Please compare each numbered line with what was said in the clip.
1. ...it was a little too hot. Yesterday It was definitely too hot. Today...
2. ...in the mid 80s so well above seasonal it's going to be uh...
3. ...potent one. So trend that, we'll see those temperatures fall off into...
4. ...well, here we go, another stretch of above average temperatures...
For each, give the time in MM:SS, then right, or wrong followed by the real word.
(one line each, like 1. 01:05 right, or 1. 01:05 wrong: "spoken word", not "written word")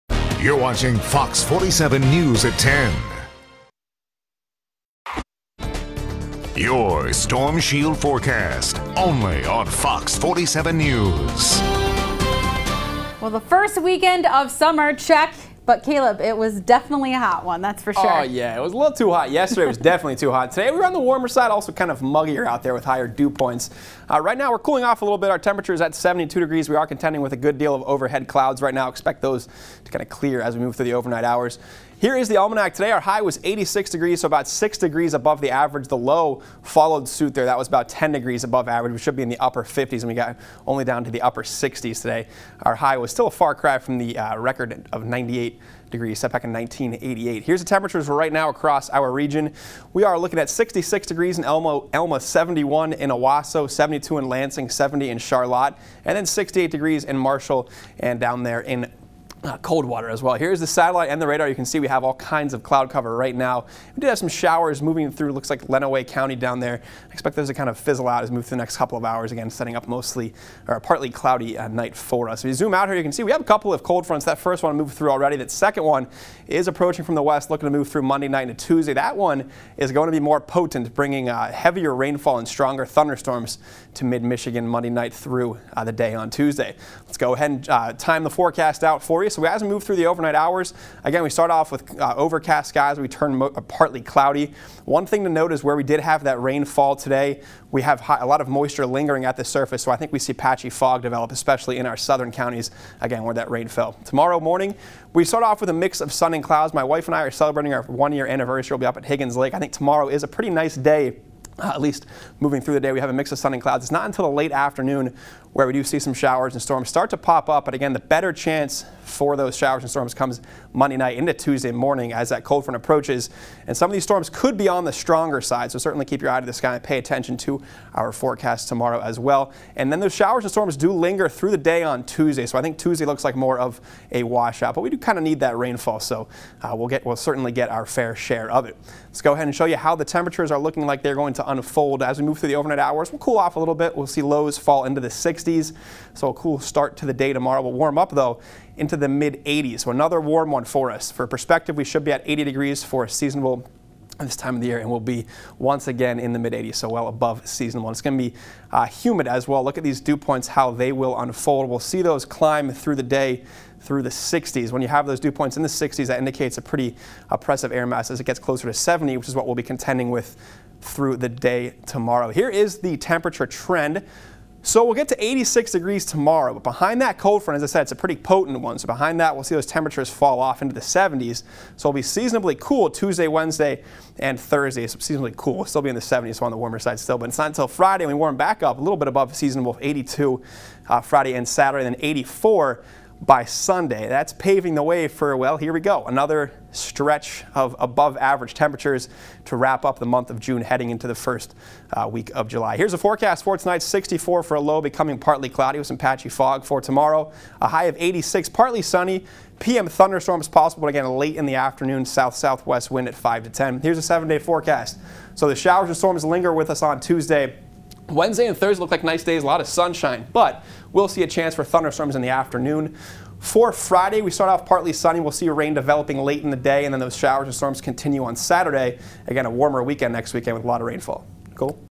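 1. 00:18 right
2. 02:36 right
3. 02:58 wrong: "behind", not "trend"
4. 03:15 right.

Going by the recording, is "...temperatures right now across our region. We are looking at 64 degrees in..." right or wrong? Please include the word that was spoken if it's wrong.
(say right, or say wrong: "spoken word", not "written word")
wrong: "66", not "64".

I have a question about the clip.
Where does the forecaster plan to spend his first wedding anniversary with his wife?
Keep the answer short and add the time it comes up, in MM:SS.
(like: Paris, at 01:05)
Higgins Lake, at 01:49.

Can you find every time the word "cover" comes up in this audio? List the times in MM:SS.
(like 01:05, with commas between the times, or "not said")
01:02.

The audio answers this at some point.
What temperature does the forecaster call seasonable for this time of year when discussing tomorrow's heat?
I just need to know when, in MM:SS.
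02:32.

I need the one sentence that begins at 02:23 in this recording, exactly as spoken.
We'll cool off a little bit.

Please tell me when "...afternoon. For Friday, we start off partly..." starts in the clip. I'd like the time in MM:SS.
03:42.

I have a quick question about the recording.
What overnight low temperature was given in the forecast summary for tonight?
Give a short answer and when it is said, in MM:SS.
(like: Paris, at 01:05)
64, at 03:23.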